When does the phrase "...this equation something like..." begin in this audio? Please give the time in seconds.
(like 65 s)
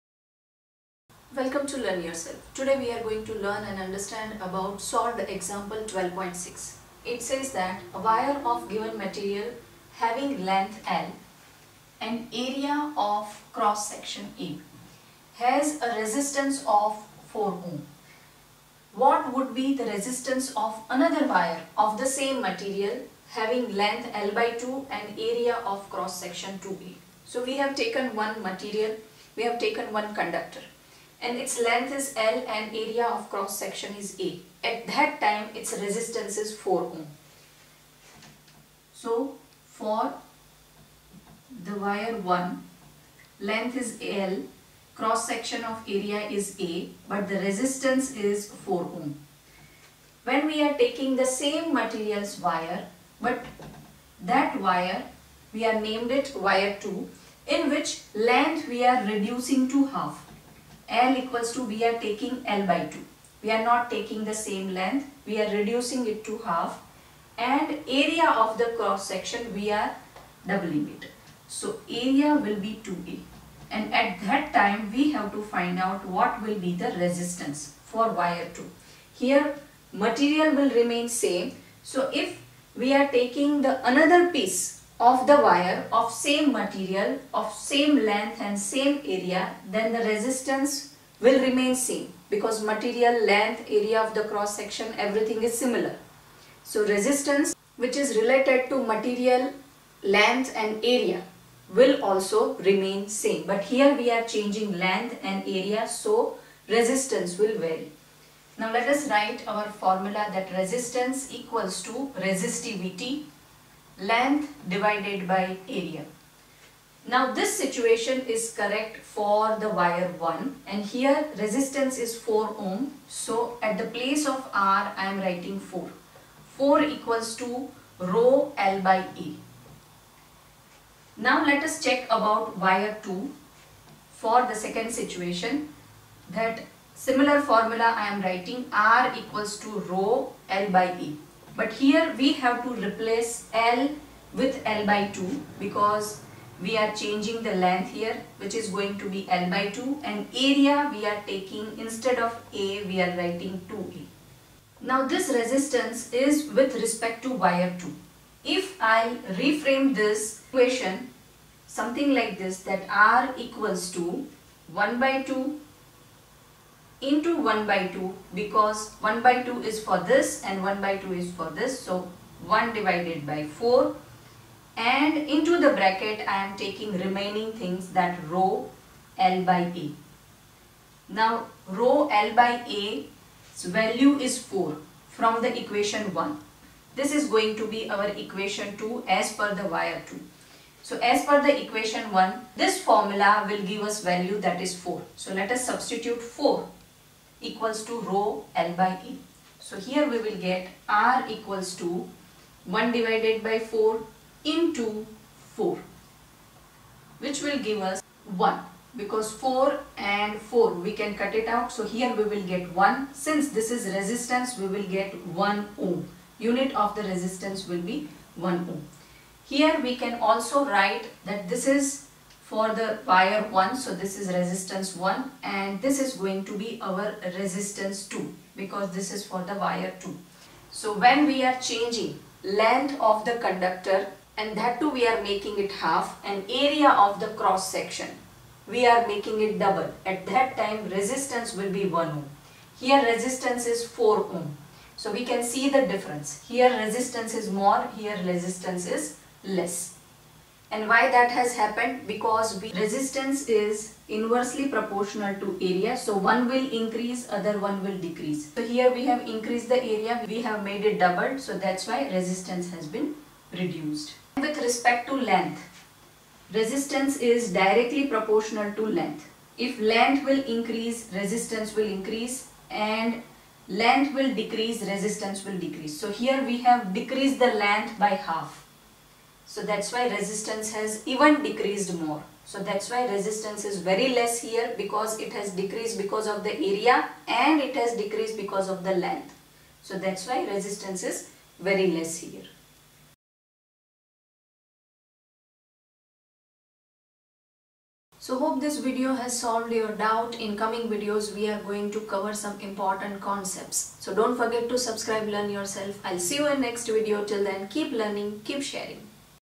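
159 s.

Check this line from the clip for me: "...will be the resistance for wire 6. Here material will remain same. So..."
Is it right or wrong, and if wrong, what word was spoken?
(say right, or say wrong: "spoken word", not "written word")
wrong: "2", not "6".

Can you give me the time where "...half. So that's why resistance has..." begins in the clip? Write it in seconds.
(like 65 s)
278 s.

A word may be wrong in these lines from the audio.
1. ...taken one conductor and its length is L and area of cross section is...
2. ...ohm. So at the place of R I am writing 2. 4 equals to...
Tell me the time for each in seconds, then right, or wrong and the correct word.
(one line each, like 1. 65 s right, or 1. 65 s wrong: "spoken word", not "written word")
1. 29 s right
2. 122 s wrong: "4", not "2".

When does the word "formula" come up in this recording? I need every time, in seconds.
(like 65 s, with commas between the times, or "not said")
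109 s, 137 s, 192 s.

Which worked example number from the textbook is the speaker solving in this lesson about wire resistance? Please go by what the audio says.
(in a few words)
12.6.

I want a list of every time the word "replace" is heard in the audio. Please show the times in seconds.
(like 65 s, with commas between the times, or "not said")
142 s.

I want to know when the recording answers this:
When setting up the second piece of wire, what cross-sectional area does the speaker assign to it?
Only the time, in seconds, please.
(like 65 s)
71 s.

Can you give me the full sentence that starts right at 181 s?
Now rho L by A's value is 4 from the equation 1.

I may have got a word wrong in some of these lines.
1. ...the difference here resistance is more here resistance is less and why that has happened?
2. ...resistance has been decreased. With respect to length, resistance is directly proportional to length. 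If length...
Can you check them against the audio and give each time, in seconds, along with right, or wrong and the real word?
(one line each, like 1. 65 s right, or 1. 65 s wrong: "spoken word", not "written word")
1. 245 s right
2. 262 s wrong: "reduced", not "decreased".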